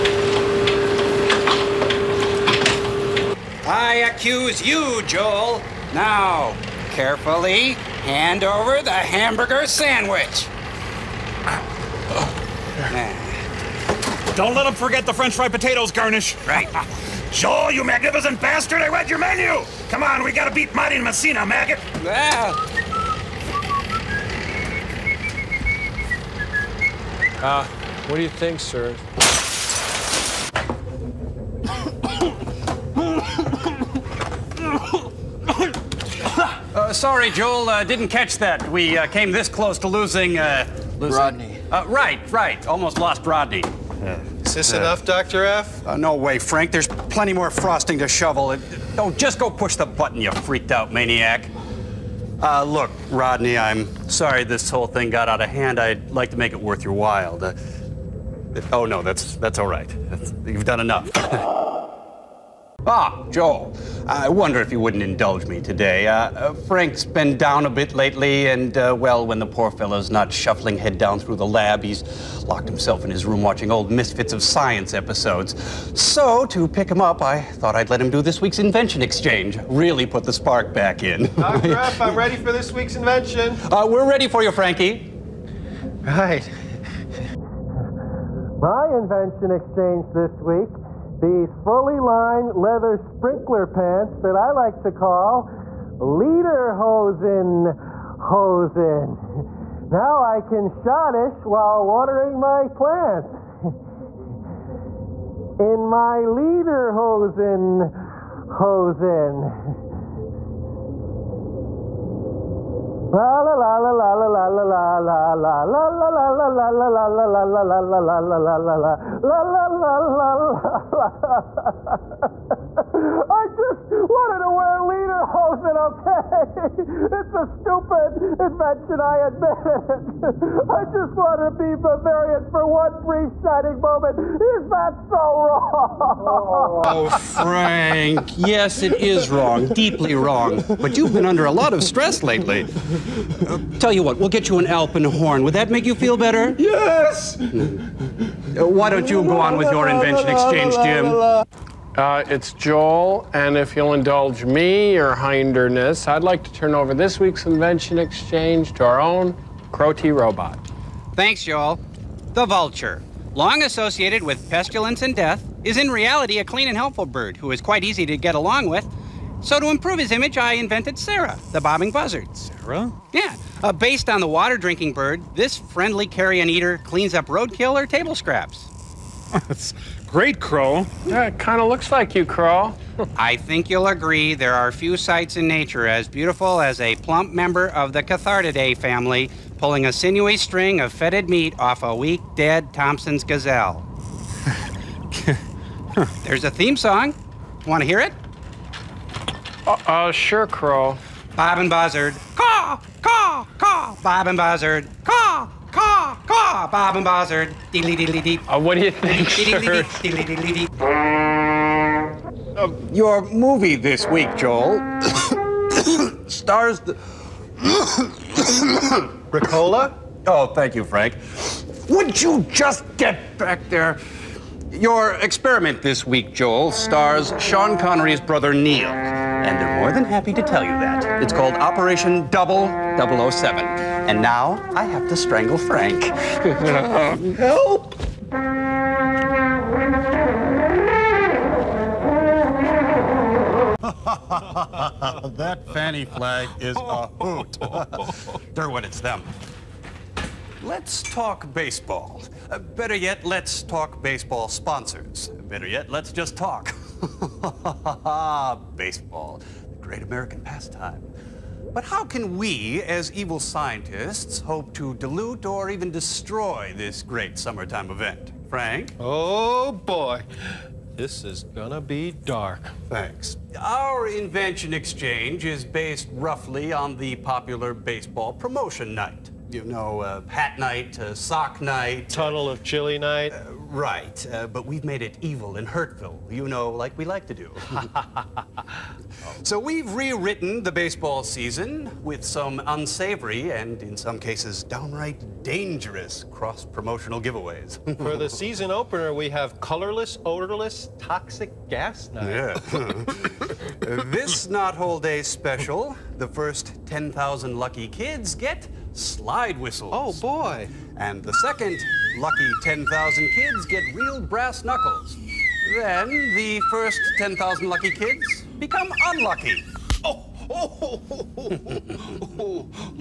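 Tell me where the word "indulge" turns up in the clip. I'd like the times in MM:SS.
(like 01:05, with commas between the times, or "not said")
01:05, 02:33.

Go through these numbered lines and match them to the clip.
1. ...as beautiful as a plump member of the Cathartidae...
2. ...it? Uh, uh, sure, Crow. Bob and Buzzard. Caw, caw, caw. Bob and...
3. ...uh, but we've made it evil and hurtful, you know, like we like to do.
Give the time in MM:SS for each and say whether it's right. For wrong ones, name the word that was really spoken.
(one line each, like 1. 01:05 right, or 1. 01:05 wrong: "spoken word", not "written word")
1. 03:05 right
2. 03:18 right
3. 04:44 right.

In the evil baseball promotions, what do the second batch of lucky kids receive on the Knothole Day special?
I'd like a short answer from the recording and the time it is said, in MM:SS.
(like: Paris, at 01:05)
Real brass knuckles, at 05:13.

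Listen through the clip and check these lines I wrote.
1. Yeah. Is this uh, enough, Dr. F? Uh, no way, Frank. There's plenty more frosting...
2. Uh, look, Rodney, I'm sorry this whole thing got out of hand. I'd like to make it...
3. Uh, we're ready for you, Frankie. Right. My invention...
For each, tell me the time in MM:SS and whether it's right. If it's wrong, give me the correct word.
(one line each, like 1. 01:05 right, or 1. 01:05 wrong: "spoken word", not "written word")
1. 00:44 right
2. 00:52 right
3. 01:23 right.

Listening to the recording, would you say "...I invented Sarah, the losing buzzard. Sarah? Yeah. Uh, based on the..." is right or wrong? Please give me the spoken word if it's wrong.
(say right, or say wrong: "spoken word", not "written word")
wrong: "bobbing", not "losing".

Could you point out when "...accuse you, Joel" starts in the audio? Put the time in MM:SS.
00:04.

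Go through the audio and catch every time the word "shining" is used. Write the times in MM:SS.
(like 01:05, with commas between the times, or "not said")
02:13.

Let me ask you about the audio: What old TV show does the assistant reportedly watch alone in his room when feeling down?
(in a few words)
Misfits of Science.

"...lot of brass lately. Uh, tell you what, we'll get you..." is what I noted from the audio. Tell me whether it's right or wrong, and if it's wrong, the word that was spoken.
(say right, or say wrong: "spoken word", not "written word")
wrong: "stress", not "brass".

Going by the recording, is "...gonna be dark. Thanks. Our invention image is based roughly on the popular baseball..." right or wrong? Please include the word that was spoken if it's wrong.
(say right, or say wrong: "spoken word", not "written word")
wrong: "exchange", not "image".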